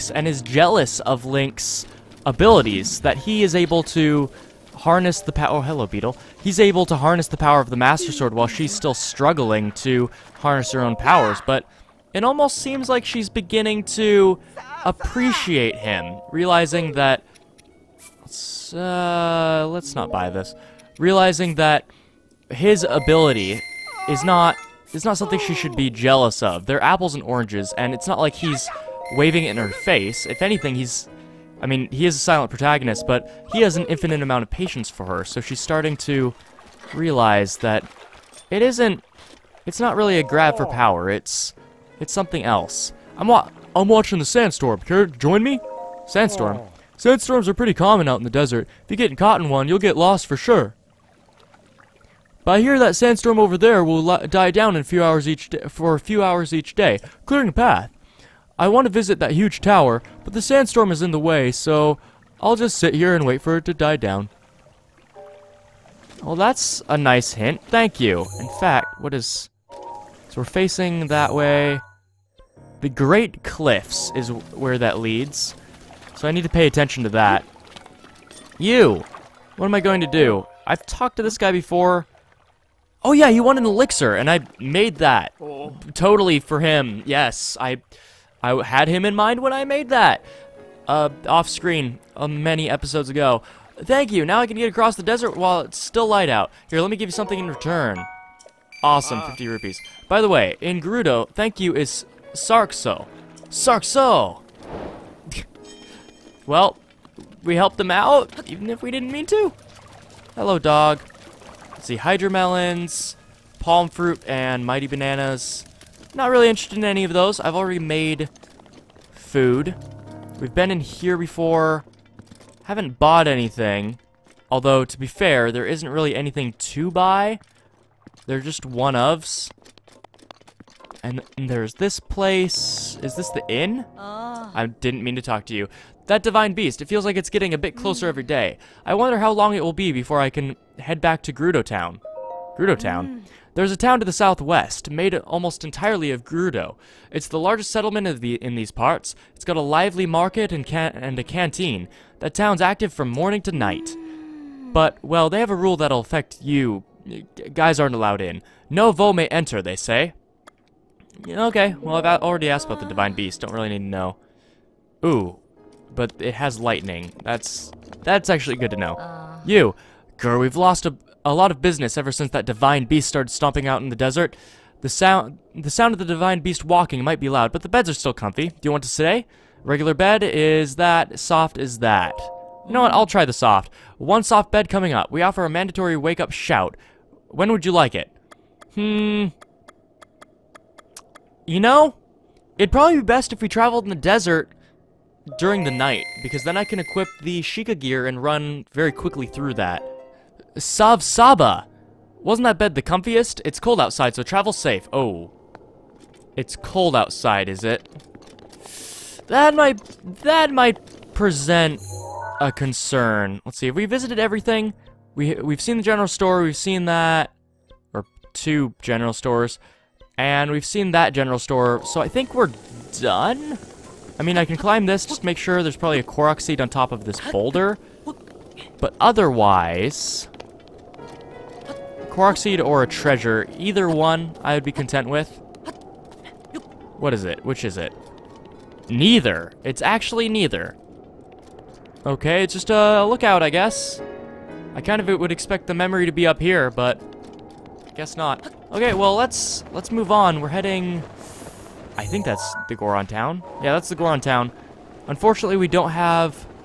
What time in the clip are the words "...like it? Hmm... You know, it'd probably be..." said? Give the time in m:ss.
3:07.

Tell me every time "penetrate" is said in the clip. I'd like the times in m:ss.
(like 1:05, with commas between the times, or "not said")
not said.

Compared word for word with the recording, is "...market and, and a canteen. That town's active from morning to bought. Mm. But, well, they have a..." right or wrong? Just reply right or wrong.
wrong.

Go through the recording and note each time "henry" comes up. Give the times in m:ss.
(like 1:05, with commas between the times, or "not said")
not said.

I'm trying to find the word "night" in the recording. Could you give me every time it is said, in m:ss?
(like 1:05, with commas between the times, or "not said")
2:33, 3:15.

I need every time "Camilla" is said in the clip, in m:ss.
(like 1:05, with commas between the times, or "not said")
not said.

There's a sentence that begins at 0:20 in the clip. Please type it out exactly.
Realizing that his ability is not it's not something she should be jealous of.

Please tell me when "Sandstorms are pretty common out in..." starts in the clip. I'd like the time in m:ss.
0:47.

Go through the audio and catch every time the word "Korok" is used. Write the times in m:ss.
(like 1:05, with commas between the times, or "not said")
3:46, 3:52.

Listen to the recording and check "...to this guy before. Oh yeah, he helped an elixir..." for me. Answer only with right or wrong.
wrong.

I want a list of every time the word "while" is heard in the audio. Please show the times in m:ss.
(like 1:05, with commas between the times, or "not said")
0:08, 1:35.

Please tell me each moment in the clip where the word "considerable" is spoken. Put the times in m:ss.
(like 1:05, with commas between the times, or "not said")
not said.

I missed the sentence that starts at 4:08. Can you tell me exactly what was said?
Okay, well, let's let's move on.